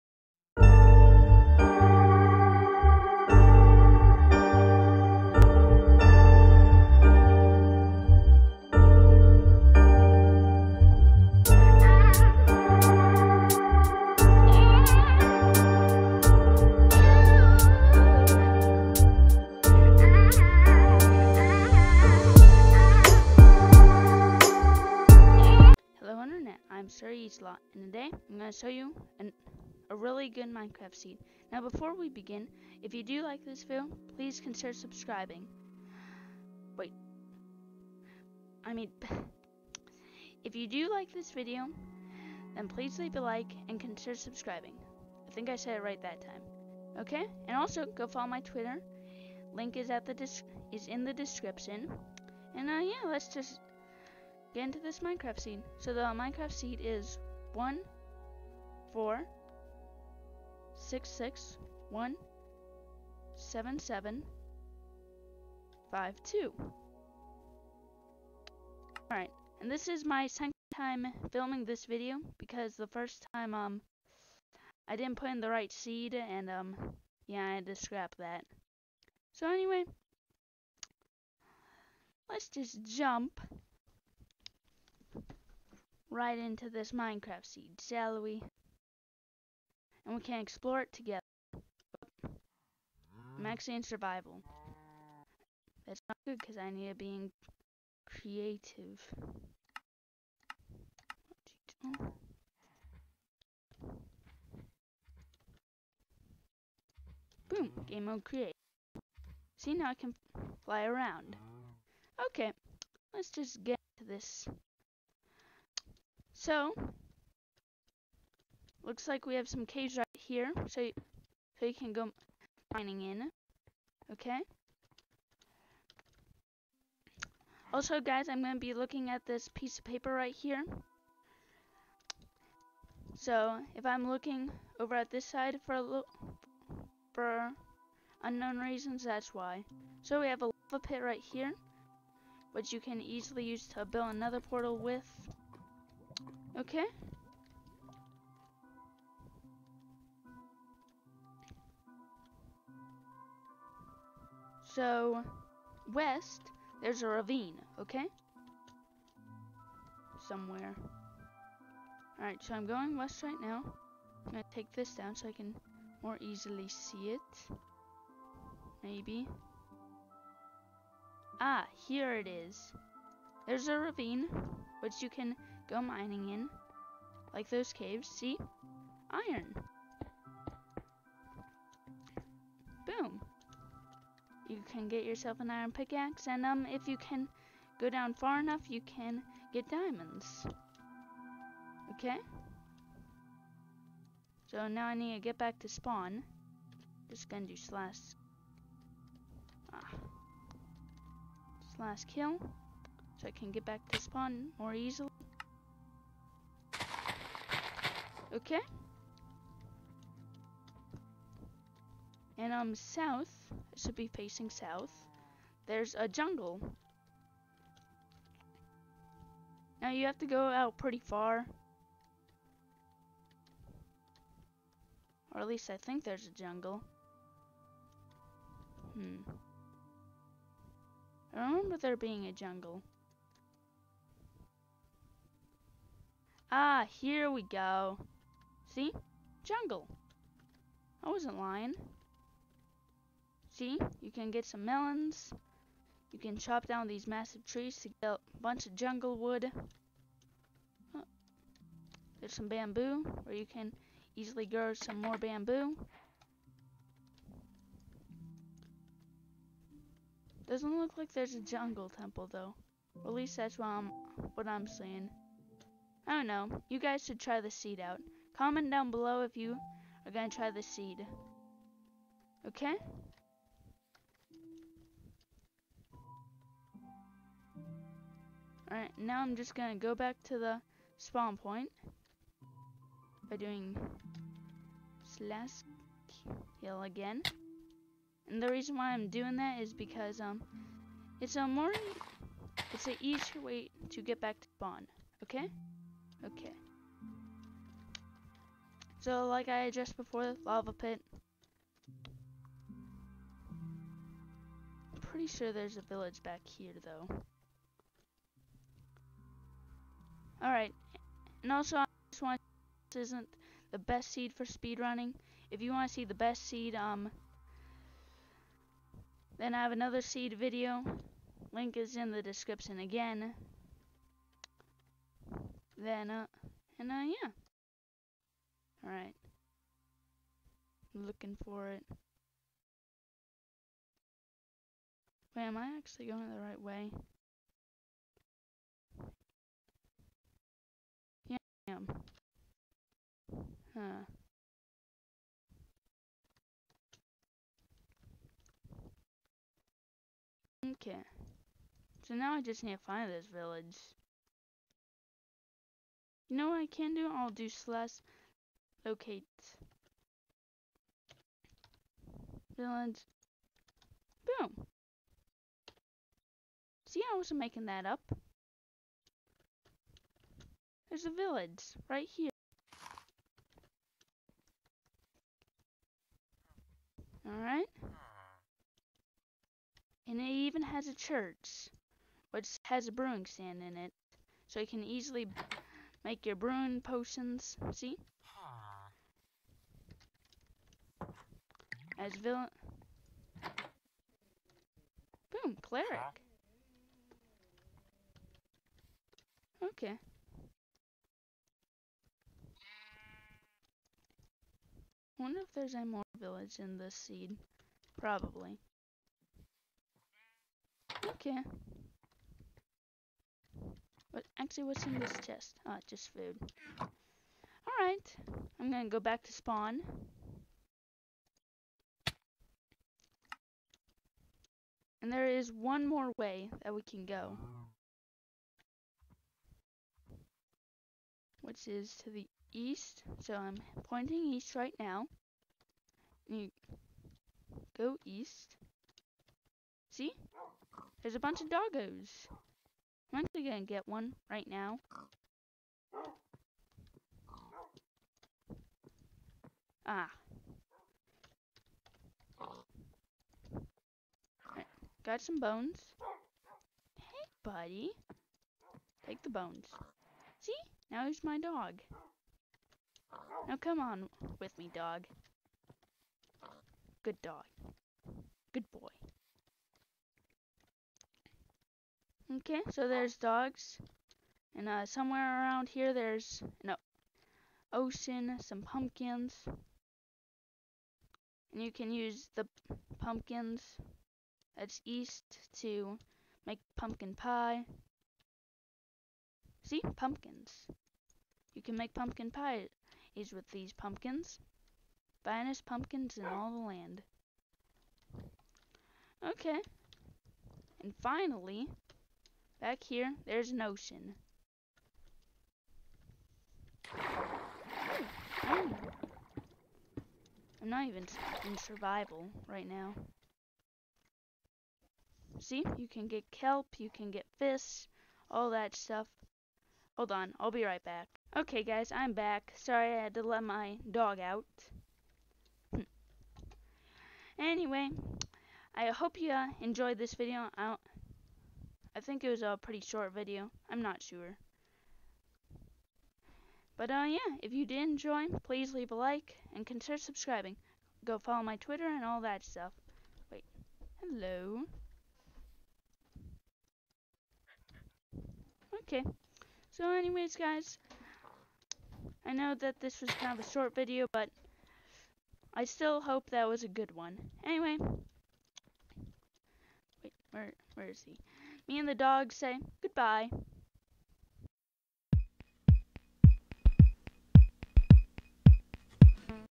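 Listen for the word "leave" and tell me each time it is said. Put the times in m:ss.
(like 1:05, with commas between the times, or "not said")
0:42, 8:58.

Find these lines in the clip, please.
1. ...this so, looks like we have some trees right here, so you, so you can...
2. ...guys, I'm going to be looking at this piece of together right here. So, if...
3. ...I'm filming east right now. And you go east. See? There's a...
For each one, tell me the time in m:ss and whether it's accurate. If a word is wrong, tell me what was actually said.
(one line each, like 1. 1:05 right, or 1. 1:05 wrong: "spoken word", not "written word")
1. 1:54 wrong: "caves", not "trees"
2. 2:08 wrong: "paper", not "together"
3. 7:13 wrong: "pointing", not "filming".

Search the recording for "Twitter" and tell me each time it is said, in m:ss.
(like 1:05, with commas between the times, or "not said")
0:48, 9:01.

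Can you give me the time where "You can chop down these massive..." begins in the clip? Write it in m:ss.
4:06.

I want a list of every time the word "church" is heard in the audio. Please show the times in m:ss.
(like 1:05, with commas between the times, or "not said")
6:20.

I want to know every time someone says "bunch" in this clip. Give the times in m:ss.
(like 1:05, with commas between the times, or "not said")
4:08, 7:21.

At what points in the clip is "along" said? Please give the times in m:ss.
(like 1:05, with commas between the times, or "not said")
not said.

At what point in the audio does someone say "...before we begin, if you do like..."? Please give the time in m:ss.
0:31.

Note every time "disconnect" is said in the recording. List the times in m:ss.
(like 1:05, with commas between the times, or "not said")
not said.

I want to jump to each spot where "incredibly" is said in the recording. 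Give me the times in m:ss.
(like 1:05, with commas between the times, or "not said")
not said.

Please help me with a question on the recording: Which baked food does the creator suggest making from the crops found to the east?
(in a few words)
Pumpkin pie.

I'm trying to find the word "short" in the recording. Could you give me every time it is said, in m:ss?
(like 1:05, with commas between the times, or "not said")
8:52, 9:13.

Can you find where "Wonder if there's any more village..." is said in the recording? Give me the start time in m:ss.
6:45.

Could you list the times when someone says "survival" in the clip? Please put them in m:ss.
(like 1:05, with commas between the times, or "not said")
1:33, 8:31.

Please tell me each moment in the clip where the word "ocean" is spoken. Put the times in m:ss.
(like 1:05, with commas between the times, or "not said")
7:57, 8:23.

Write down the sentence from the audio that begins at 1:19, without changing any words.
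So anyway, let's just jump right into this Minecraft seed, shall we?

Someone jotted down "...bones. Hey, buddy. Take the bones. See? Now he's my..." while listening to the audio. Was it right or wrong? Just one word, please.
right.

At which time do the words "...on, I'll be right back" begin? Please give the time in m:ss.
8:40.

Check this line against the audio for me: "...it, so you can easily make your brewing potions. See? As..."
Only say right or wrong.
right.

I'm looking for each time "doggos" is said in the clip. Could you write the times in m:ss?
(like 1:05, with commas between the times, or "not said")
7:21.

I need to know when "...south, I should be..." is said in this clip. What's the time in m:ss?
3:32.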